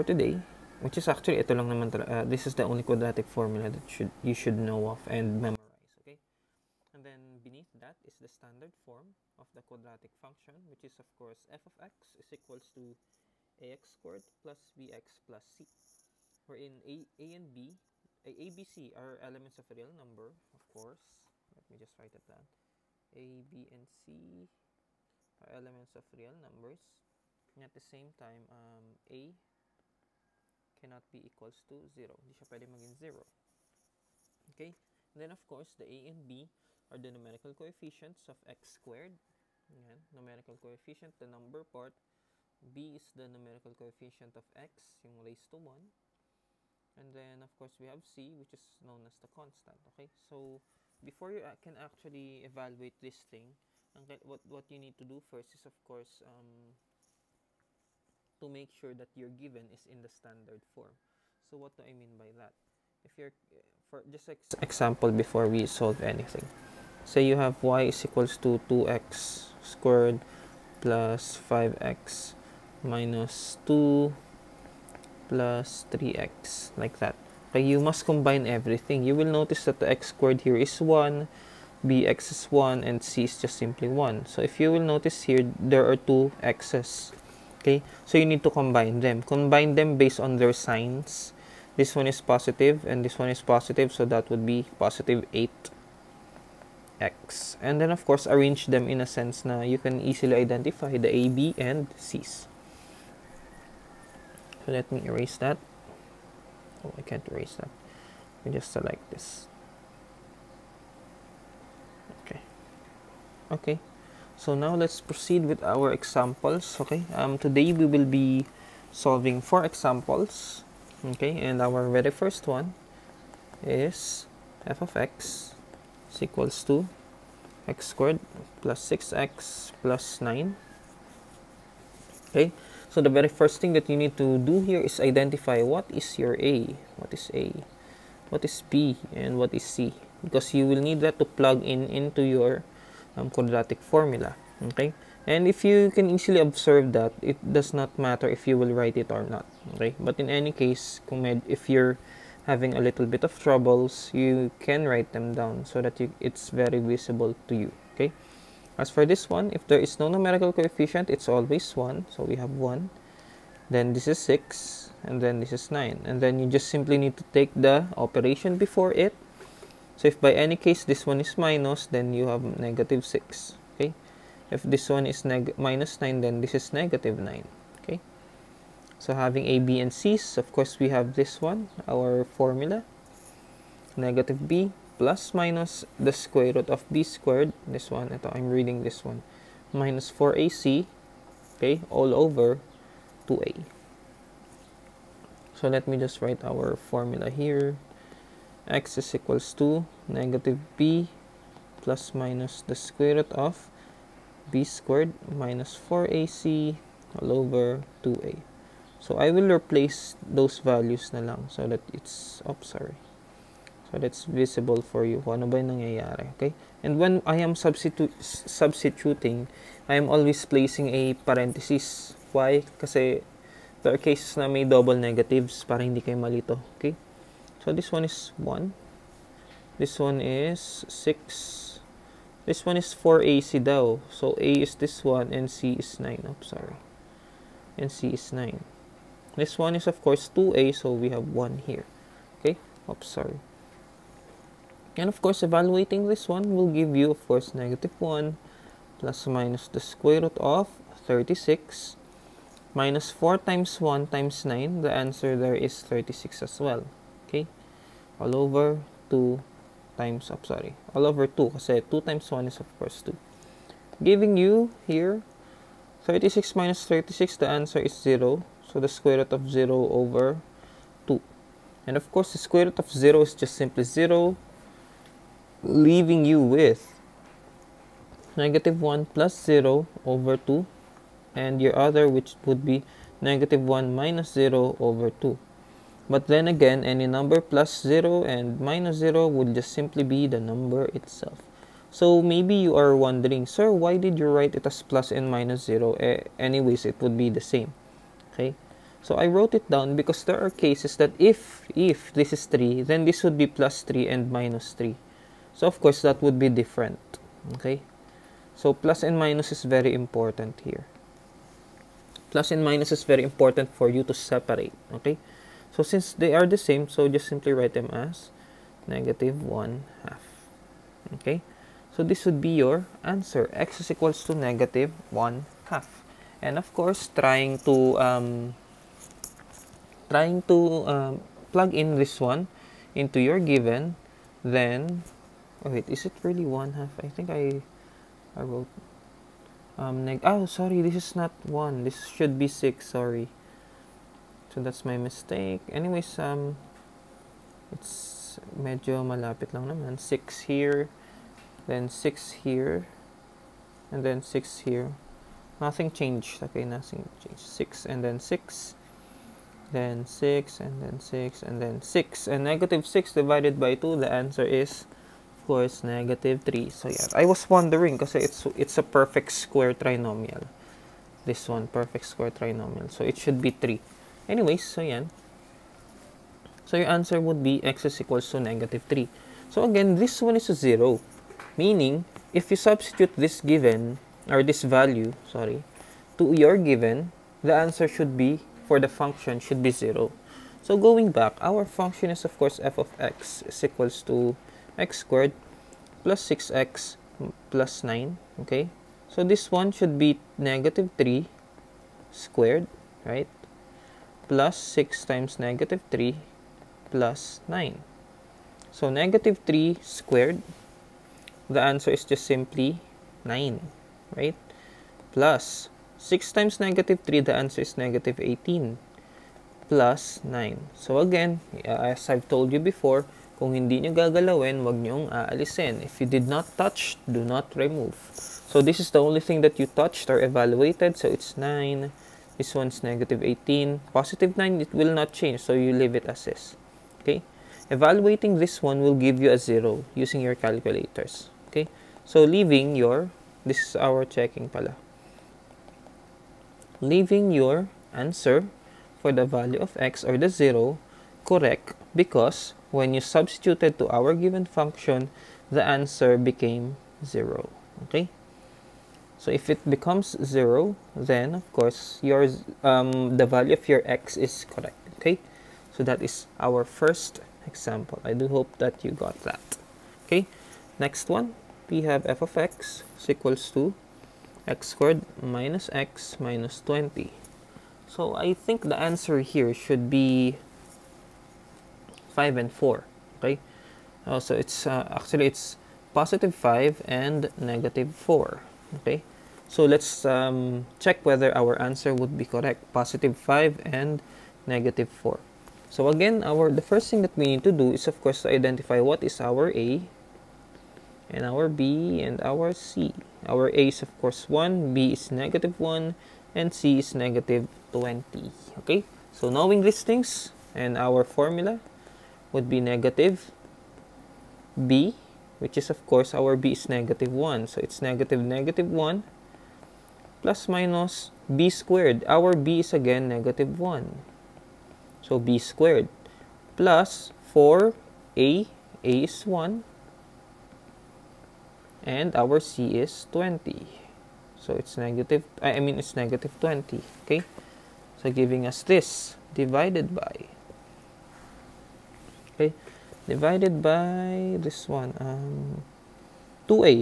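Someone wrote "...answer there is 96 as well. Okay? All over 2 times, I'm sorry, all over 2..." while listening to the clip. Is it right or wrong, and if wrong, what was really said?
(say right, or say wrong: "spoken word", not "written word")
wrong: "36", not "96".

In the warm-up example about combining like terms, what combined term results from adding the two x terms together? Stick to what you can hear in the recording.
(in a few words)
positive 8x.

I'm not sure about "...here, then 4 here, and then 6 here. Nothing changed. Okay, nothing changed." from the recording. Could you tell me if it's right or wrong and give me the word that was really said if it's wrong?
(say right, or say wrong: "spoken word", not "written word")
wrong: "6", not "4".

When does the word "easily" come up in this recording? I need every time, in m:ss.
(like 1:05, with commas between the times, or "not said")
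1:39, 2:26.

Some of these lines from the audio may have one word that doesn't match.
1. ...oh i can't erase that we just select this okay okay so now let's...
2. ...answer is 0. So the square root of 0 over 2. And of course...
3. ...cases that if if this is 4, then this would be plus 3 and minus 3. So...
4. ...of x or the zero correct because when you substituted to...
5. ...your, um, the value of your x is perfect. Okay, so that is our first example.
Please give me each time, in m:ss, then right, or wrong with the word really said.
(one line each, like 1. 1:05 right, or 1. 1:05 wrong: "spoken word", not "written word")
1. 1:46 right
2. 4:27 right
3. 5:00 wrong: "3", not "4"
4. 7:29 right
5. 7:42 wrong: "correct", not "perfect".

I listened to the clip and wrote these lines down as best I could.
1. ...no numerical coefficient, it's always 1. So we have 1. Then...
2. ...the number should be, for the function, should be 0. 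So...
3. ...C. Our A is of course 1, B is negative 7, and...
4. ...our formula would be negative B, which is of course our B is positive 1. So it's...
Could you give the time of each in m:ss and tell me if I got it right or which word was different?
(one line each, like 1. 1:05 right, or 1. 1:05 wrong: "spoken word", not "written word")
1. 2:39 right
2. 6:27 wrong: "answer", not "number"
3. 8:22 wrong: "1", not "7"
4. 8:30 wrong: "negative", not "positive".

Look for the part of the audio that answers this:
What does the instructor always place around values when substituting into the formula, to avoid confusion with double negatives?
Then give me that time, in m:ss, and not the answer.
3:41.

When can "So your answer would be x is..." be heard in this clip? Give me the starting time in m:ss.
6:16.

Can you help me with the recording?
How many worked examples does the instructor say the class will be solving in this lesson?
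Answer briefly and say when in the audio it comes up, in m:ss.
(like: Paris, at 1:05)
4, at 1:59.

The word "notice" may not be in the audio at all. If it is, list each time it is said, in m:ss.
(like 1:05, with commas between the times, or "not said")
1:19, 1:24.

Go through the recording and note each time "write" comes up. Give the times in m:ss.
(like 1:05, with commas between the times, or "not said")
0:21, 2:28, 2:34, 3:16, 4:54, 5:17.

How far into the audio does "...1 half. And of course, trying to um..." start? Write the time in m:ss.
5:25.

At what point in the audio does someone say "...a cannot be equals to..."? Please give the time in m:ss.
0:29.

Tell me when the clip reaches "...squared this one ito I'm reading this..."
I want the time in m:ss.
3:07.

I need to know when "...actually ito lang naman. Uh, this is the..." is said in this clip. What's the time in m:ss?
0:01.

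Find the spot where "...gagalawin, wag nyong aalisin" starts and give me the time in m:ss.
7:03.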